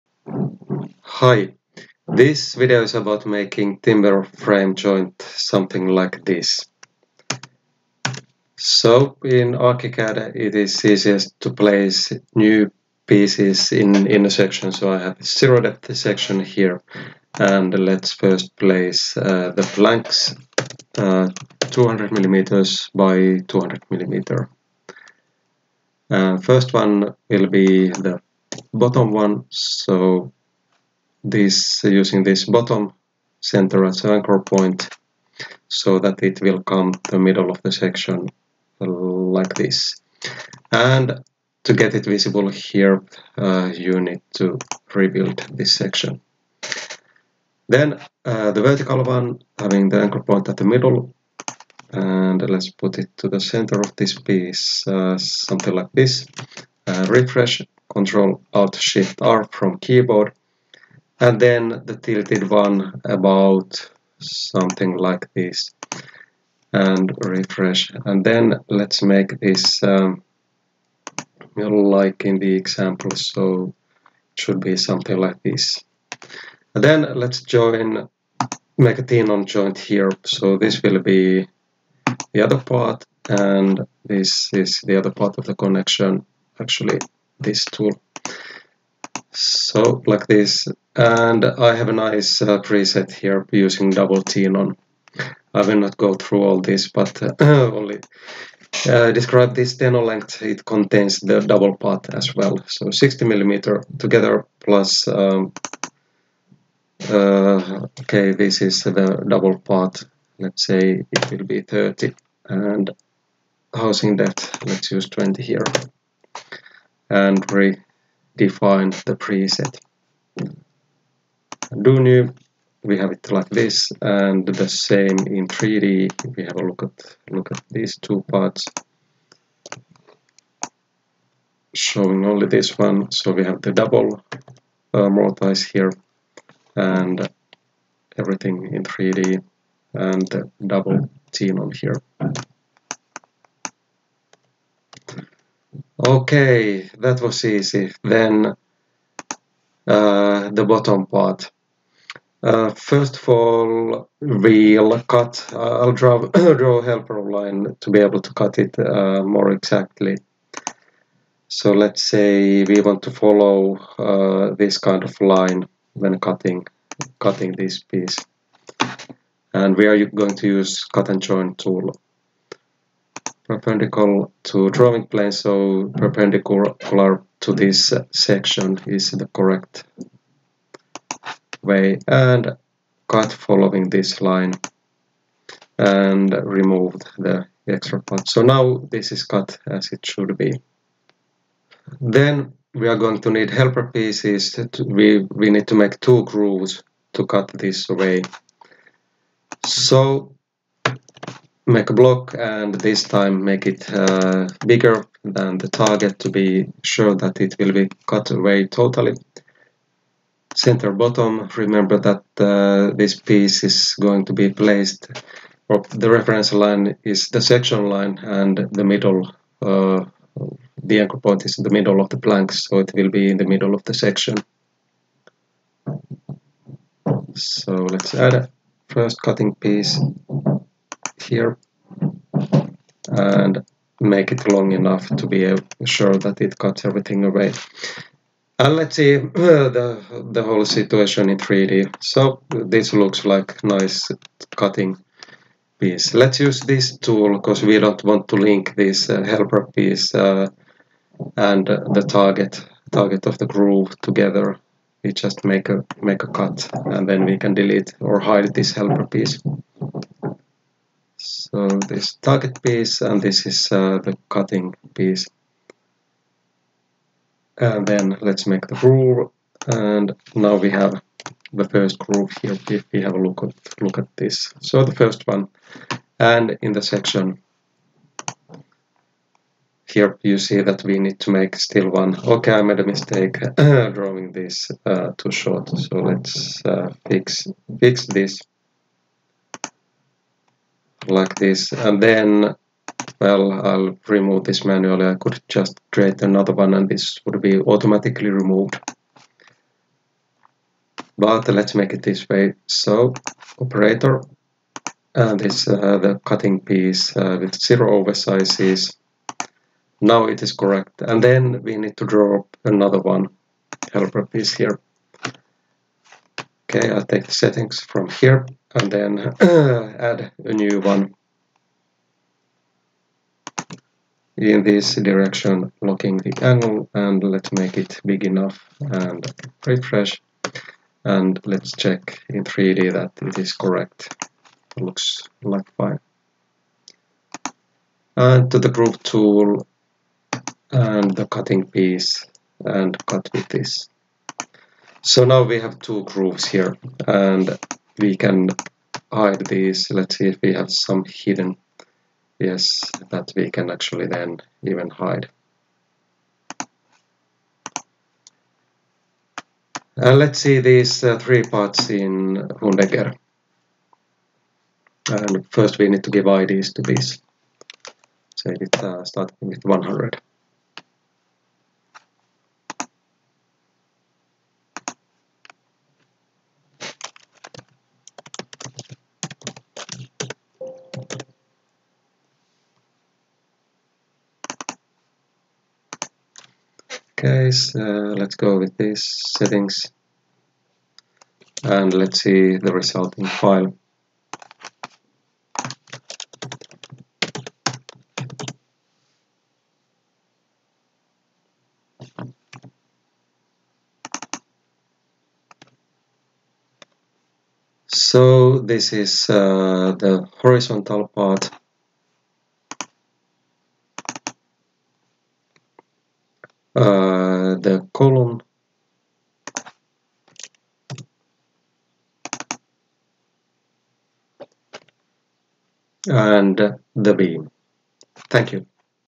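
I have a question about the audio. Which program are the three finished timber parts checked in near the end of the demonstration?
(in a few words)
Hundegger.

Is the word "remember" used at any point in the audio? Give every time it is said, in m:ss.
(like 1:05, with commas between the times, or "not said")
3:31.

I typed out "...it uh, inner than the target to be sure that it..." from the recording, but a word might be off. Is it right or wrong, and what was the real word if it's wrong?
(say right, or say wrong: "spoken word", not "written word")
wrong: "bigger", not "inner".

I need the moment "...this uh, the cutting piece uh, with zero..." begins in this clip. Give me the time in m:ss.
5:05.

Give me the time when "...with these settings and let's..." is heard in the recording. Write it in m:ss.
6:28.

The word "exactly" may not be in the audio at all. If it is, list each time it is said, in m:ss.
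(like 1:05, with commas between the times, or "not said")
2:39.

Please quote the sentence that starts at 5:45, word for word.
So now we have two grooves here and we can hide these.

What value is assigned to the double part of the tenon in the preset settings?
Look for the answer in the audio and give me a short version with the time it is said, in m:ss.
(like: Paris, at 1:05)
30, at 1:51.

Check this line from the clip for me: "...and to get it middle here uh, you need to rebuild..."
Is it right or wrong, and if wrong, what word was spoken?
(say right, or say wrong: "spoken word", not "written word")
wrong: "visible", not "middle".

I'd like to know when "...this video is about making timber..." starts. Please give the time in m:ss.
0:02.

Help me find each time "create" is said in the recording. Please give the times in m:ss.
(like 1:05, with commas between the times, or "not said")
4:55.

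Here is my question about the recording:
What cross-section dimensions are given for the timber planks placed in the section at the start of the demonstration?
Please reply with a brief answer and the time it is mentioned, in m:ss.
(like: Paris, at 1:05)
200 by 200 mm, at 0:21.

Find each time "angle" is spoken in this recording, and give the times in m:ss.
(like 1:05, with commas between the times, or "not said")
5:26.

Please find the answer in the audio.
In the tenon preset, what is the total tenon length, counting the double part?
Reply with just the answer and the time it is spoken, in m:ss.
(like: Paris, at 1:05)
60 millimeters, at 1:42.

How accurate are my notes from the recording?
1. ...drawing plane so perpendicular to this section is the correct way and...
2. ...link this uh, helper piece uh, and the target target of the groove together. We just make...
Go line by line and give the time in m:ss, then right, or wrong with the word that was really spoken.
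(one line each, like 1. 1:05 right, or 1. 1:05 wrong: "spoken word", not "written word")
1. 2:54 right
2. 4:08 right.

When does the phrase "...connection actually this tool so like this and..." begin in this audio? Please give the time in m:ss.
1:25.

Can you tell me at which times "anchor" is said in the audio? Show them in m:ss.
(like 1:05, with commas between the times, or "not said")
0:34, 0:50, 3:40.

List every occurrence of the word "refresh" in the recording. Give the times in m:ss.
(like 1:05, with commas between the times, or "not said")
0:57, 1:07, 5:29.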